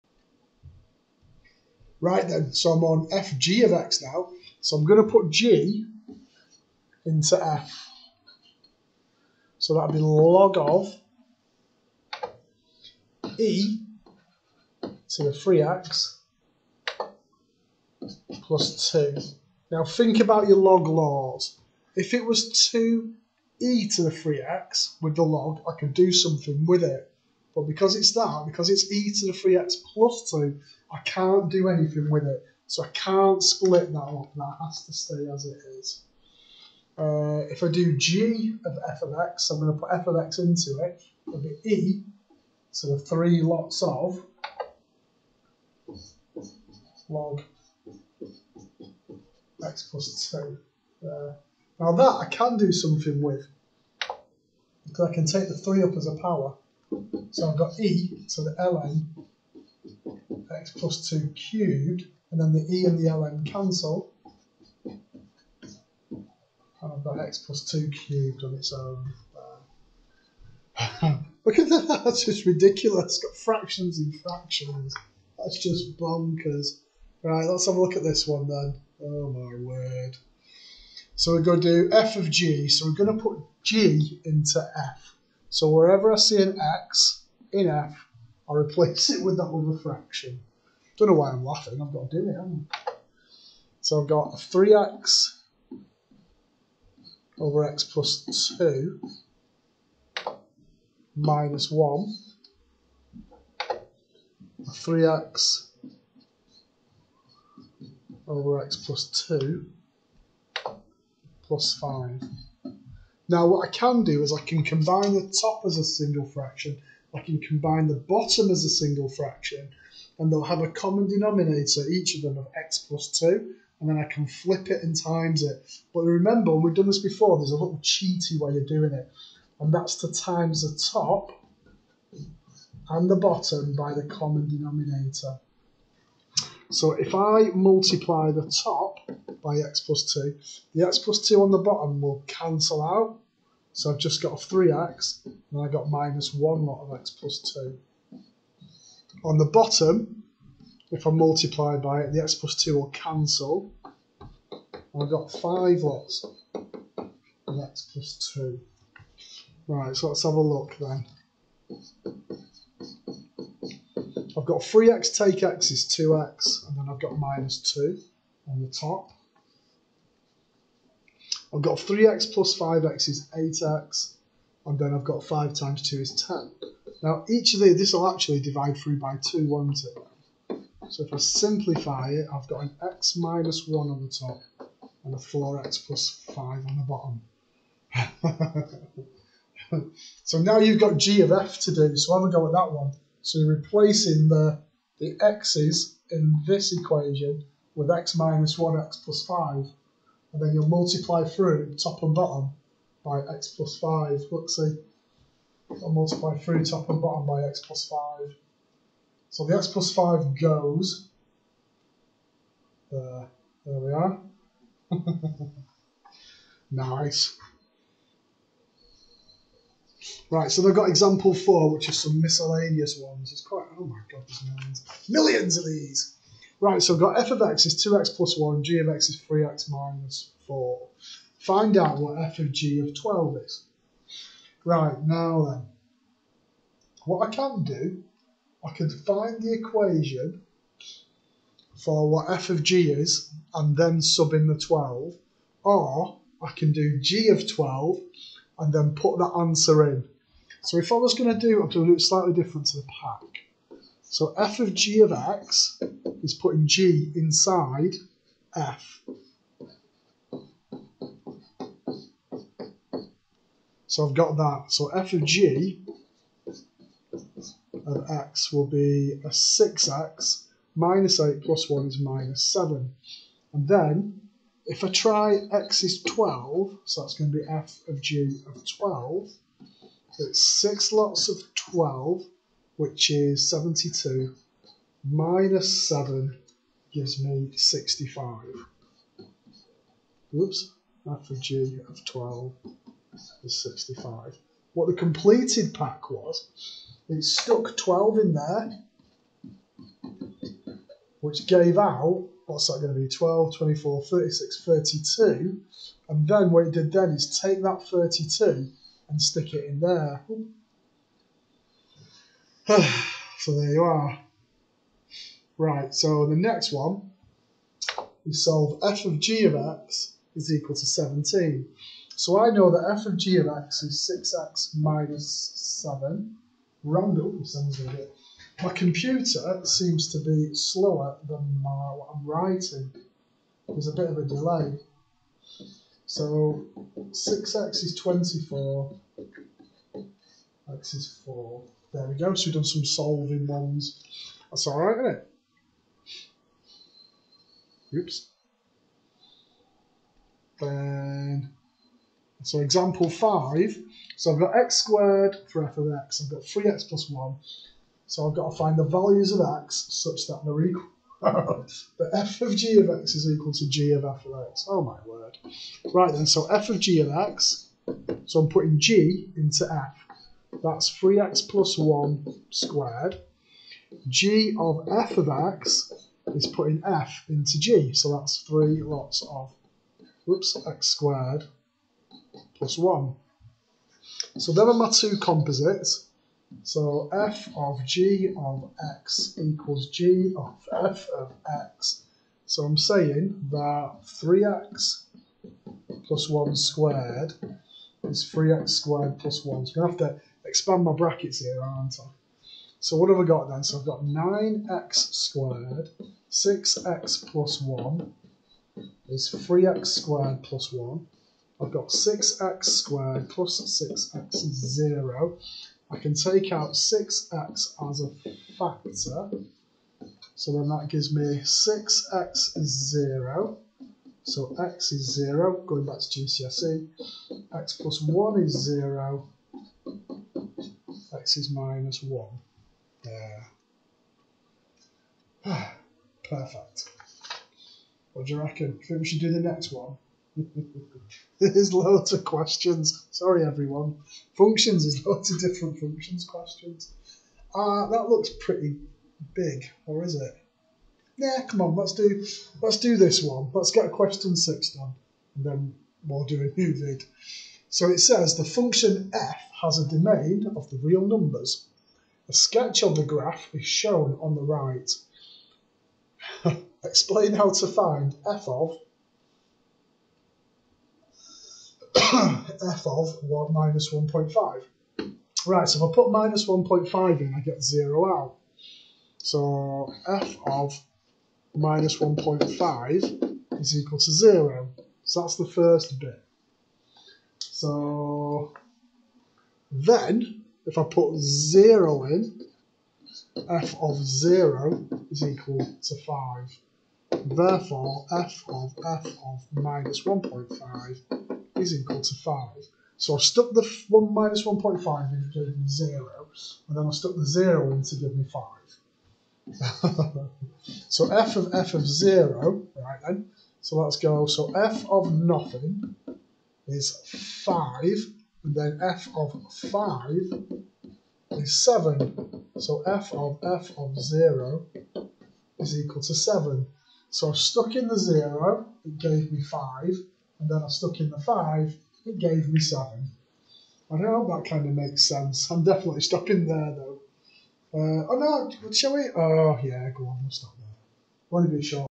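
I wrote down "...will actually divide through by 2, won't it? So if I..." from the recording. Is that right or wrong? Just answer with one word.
right.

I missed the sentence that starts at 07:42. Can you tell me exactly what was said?
A sketch of the graph is shown on the right.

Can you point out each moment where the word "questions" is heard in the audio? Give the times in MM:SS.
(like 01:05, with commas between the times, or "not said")
07:22, 07:26, 07:33.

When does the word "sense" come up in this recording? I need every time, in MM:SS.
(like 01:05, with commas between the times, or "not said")
08:55.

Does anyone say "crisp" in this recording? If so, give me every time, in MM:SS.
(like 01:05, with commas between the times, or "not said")
not said.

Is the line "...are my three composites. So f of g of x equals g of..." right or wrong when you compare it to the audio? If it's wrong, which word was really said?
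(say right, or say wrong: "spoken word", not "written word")
wrong: "two", not "three".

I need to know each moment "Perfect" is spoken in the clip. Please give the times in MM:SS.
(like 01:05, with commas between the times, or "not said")
07:16.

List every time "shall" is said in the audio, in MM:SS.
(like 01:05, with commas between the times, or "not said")
08:58.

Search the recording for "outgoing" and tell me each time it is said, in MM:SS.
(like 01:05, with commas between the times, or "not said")
not said.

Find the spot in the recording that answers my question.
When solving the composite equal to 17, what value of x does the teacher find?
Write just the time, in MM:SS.
05:40.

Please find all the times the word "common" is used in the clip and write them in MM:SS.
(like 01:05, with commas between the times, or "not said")
02:00, 02:14.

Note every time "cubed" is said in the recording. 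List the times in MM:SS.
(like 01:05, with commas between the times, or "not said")
01:01, 01:07.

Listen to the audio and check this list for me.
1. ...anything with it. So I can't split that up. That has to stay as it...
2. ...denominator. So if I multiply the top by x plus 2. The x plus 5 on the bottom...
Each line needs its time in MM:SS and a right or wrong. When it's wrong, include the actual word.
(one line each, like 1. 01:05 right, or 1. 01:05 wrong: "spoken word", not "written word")
1. 00:31 right
2. 02:14 wrong: "2", not "5".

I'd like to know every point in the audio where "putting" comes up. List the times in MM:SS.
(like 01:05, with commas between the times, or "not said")
04:16, 06:08, 06:16.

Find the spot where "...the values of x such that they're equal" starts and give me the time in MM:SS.
05:58.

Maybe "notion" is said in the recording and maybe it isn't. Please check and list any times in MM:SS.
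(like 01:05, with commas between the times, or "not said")
not said.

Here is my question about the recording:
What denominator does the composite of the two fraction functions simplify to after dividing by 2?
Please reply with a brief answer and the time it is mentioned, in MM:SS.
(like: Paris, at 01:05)
4x + 5, at 03:05.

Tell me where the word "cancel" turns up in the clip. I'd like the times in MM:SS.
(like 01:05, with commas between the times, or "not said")
01:03, 02:22, 02:32.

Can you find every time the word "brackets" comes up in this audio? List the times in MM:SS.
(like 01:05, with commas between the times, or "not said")
06:40.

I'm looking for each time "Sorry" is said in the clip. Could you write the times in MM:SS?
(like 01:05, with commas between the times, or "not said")
07:23.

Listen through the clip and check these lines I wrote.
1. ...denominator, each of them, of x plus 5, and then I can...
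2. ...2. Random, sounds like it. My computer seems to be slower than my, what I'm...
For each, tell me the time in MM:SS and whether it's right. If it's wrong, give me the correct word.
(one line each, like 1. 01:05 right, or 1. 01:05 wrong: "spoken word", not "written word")
1. 02:01 wrong: "2", not "5"
2. 05:25 wrong: "7", not "2".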